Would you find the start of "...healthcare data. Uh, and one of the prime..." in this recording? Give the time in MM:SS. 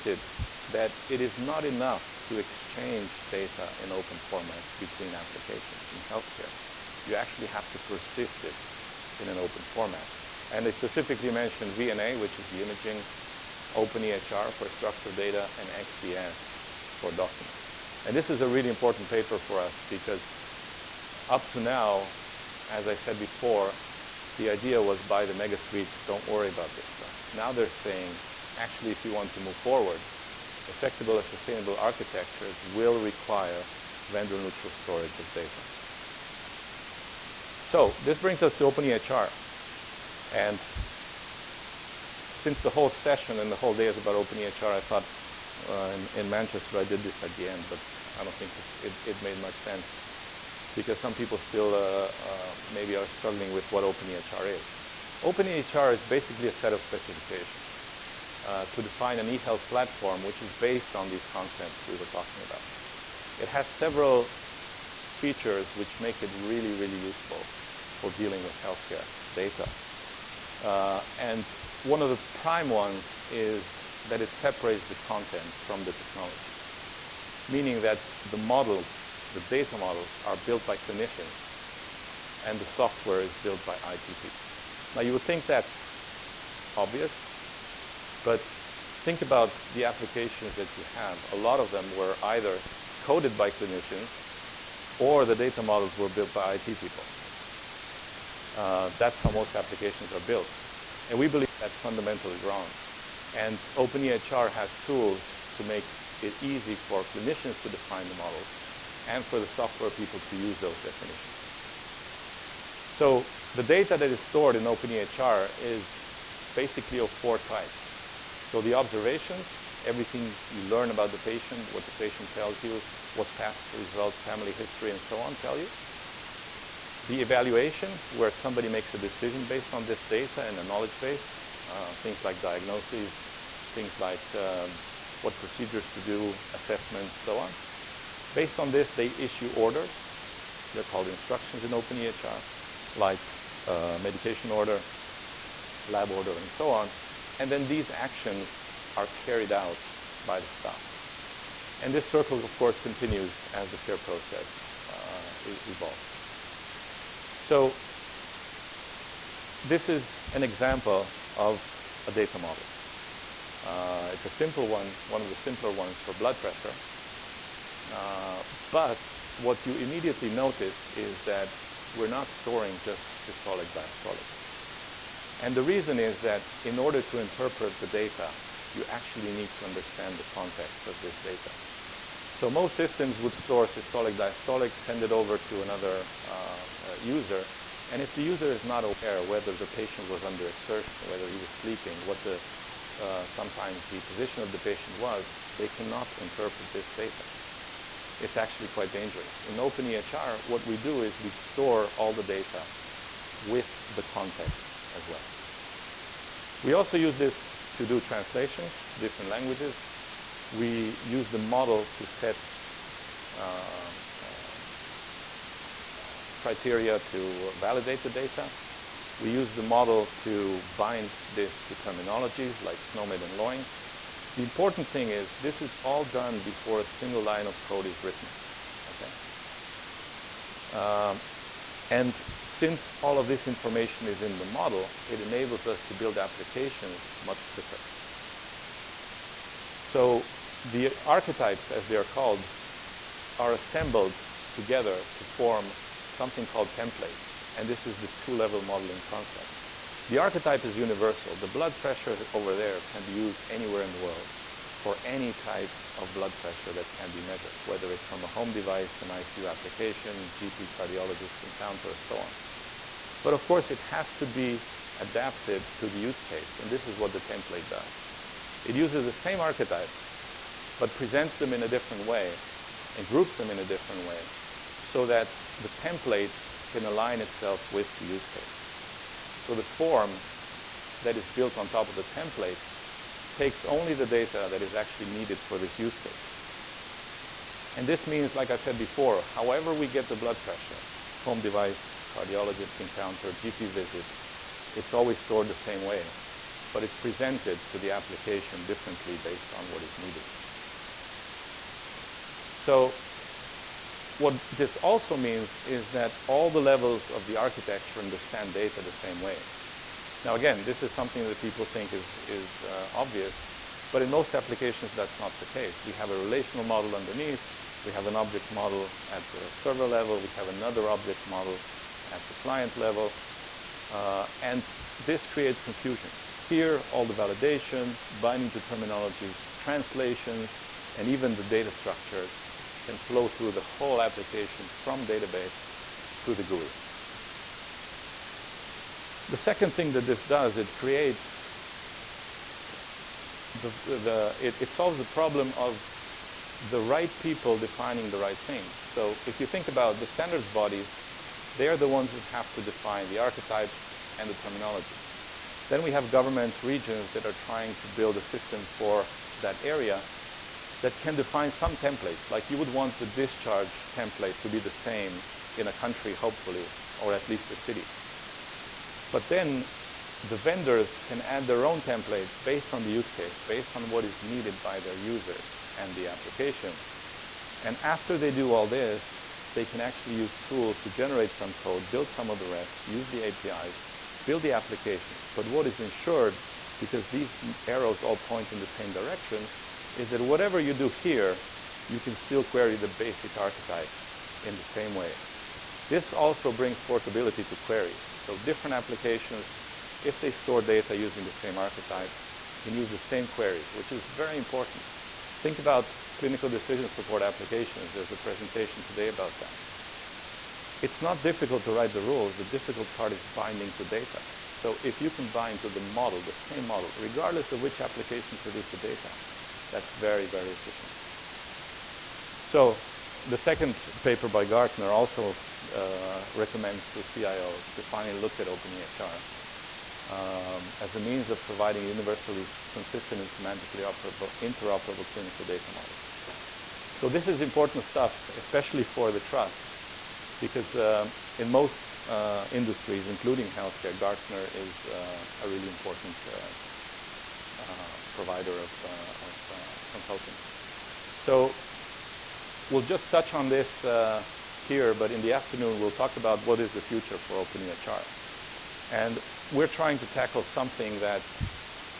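01:08.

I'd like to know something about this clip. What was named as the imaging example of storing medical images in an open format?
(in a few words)
VNA.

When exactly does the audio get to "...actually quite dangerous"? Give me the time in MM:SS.
03:18.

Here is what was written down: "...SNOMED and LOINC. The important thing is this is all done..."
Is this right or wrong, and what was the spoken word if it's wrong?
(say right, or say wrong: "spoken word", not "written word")
right.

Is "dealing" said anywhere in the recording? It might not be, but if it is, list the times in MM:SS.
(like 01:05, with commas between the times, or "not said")
01:08.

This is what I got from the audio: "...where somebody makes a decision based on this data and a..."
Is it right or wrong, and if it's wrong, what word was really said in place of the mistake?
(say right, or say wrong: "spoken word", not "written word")
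right.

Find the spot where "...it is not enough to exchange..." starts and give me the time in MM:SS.
00:01.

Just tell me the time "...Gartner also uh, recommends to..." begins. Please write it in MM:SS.
07:04.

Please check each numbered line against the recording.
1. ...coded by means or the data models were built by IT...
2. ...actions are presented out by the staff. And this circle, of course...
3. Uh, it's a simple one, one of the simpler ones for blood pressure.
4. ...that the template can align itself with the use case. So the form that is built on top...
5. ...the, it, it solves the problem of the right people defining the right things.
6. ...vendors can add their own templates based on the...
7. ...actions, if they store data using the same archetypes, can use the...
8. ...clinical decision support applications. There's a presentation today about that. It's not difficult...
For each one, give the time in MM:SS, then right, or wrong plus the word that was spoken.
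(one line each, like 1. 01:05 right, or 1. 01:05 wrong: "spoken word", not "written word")
1. 01:32 wrong: "clinicians", not "means"
2. 02:27 wrong: "carried", not "presented"
3. 02:43 right
4. 04:35 right
5. 05:43 right
6. 06:10 right
7. 06:38 wrong: "applications", not "actions"
8. 06:46 right.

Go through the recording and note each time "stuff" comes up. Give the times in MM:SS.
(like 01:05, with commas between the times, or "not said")
00:26, 07:17.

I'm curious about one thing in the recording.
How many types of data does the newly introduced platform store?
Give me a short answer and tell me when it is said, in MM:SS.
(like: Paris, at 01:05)
4, at 01:57.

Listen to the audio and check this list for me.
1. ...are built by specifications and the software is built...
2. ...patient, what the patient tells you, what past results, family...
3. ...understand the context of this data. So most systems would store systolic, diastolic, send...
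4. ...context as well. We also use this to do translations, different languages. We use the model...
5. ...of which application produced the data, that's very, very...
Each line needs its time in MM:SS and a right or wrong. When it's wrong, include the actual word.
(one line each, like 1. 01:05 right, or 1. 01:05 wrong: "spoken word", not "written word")
1. 01:20 wrong: "clinicians", not "specifications"
2. 02:01 right
3. 02:59 right
4. 03:24 right
5. 06:57 right.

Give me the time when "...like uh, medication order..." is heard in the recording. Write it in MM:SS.
02:22.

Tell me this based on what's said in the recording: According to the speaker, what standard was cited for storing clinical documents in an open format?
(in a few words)
XDS.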